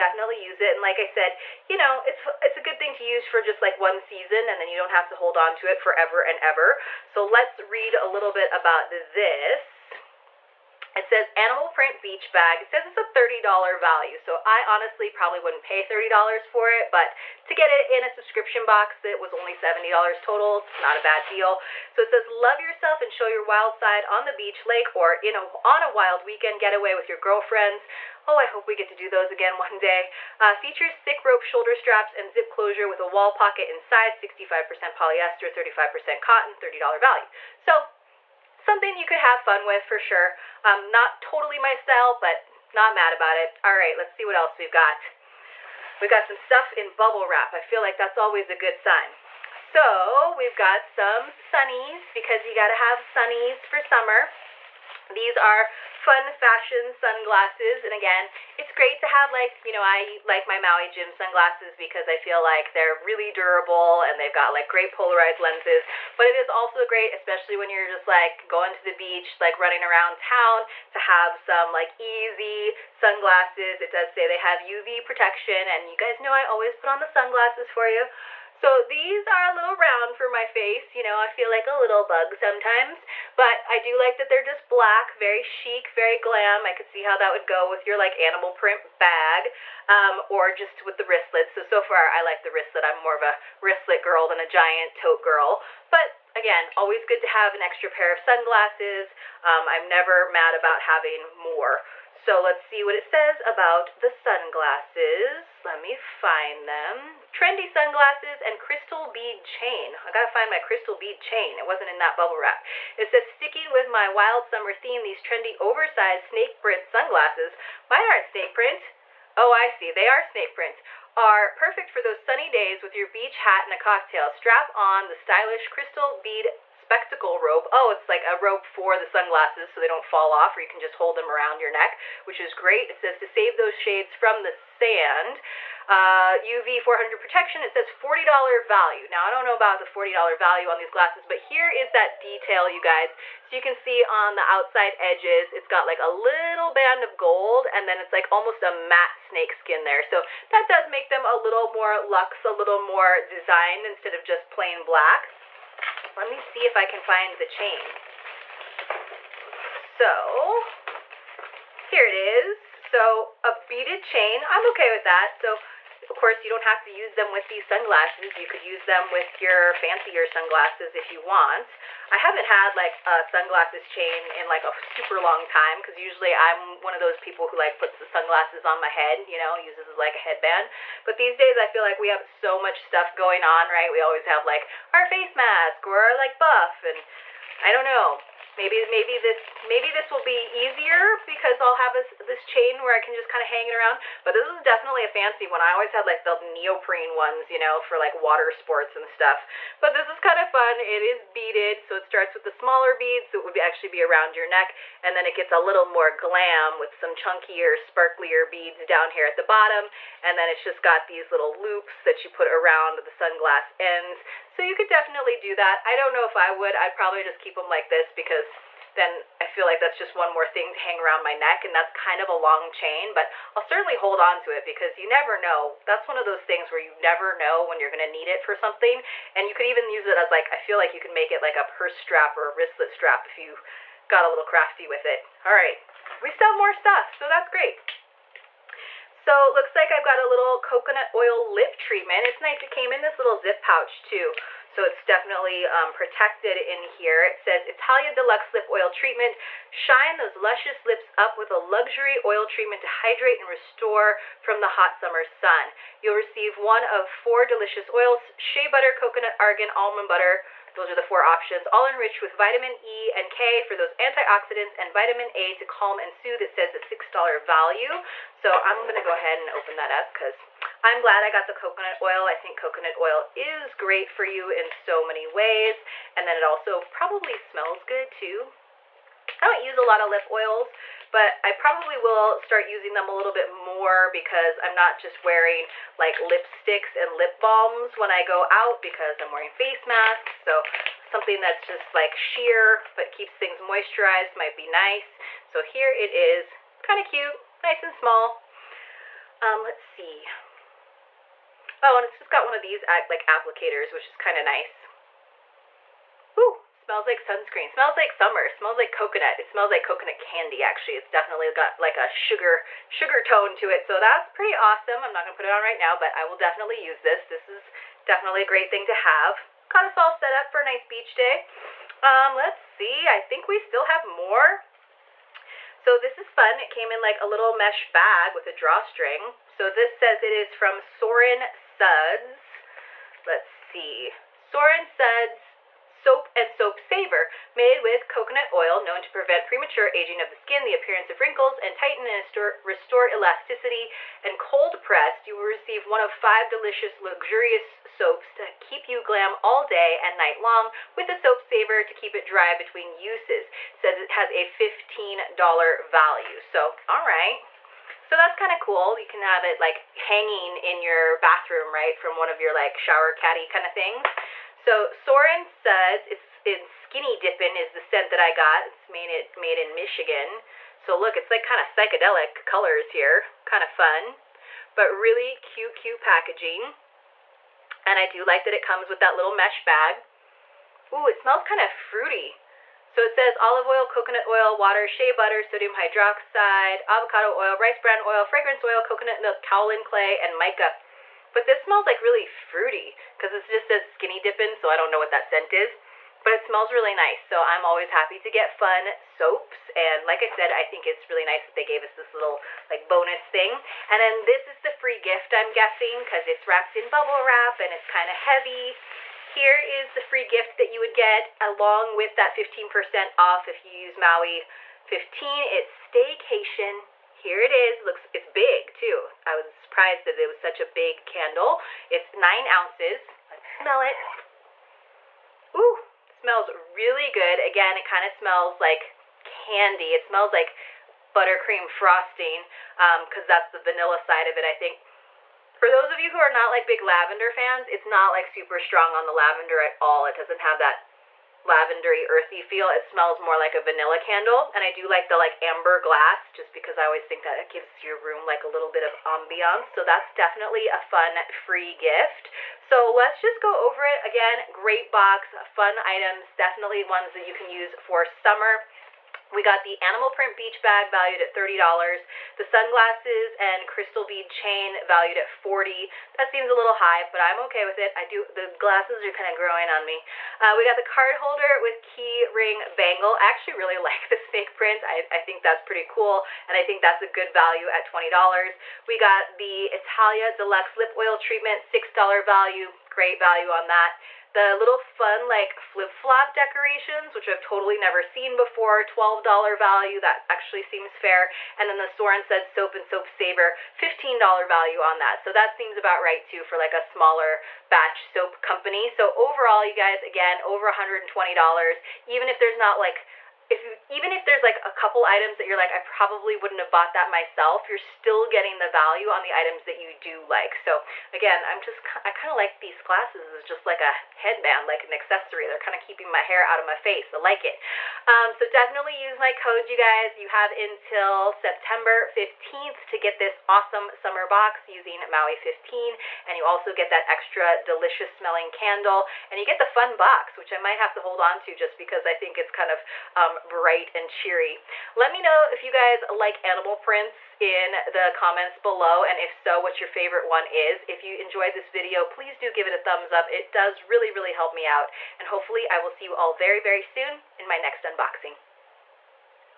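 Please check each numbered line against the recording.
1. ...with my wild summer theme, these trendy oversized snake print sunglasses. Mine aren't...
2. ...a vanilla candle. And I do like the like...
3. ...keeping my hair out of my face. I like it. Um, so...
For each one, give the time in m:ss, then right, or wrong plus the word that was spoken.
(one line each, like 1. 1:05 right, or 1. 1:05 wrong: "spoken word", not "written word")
1. 1:53 right
2. 7:23 right
3. 8:35 right.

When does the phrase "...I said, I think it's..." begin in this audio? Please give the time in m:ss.
6:40.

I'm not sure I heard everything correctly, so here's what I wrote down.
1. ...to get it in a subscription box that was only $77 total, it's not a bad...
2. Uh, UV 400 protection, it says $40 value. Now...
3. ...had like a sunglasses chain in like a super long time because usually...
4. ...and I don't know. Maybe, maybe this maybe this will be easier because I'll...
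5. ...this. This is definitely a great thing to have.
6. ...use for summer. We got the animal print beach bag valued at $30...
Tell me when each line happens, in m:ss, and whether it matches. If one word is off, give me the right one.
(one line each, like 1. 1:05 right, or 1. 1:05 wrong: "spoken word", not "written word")
1. 0:17 wrong: "70", not "77"
2. 2:15 right
3. 2:52 right
4. 3:06 right
5. 5:16 right
6. 7:37 right.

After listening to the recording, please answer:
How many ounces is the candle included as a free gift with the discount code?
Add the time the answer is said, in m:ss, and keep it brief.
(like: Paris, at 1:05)
9 ounces, at 7:02.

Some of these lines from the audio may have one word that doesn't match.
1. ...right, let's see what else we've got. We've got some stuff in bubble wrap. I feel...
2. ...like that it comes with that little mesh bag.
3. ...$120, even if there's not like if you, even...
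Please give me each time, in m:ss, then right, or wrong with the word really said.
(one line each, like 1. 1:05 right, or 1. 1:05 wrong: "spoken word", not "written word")
1. 0:43 right
2. 6:18 right
3. 8:20 right.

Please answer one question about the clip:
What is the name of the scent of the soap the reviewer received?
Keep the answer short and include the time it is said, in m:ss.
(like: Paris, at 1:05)
Skinny Dippin', at 6:06.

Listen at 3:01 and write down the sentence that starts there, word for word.
But these days I feel like we have so much stuff going on, right?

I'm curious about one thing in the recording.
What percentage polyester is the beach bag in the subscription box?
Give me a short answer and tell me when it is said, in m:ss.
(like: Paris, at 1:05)
65%, at 0:34.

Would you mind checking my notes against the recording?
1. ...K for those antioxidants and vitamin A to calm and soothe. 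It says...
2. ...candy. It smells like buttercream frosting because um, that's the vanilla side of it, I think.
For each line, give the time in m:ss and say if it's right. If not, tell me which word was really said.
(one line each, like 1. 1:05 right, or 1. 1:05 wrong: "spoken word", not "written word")
1. 4:23 right
2. 7:09 right.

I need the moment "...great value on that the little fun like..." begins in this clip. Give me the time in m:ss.
8:02.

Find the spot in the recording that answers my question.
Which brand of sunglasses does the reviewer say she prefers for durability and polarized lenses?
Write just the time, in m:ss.
1:00.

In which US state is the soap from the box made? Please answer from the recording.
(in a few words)
Michigan.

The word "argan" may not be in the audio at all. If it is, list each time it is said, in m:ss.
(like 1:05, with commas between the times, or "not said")
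4:19.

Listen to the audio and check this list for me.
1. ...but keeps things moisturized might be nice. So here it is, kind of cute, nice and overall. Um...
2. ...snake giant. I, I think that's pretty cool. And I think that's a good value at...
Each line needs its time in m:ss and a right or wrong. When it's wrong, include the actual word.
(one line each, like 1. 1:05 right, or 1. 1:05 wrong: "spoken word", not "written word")
1. 4:52 wrong: "small", not "overall"
2. 7:54 wrong: "print", not "giant".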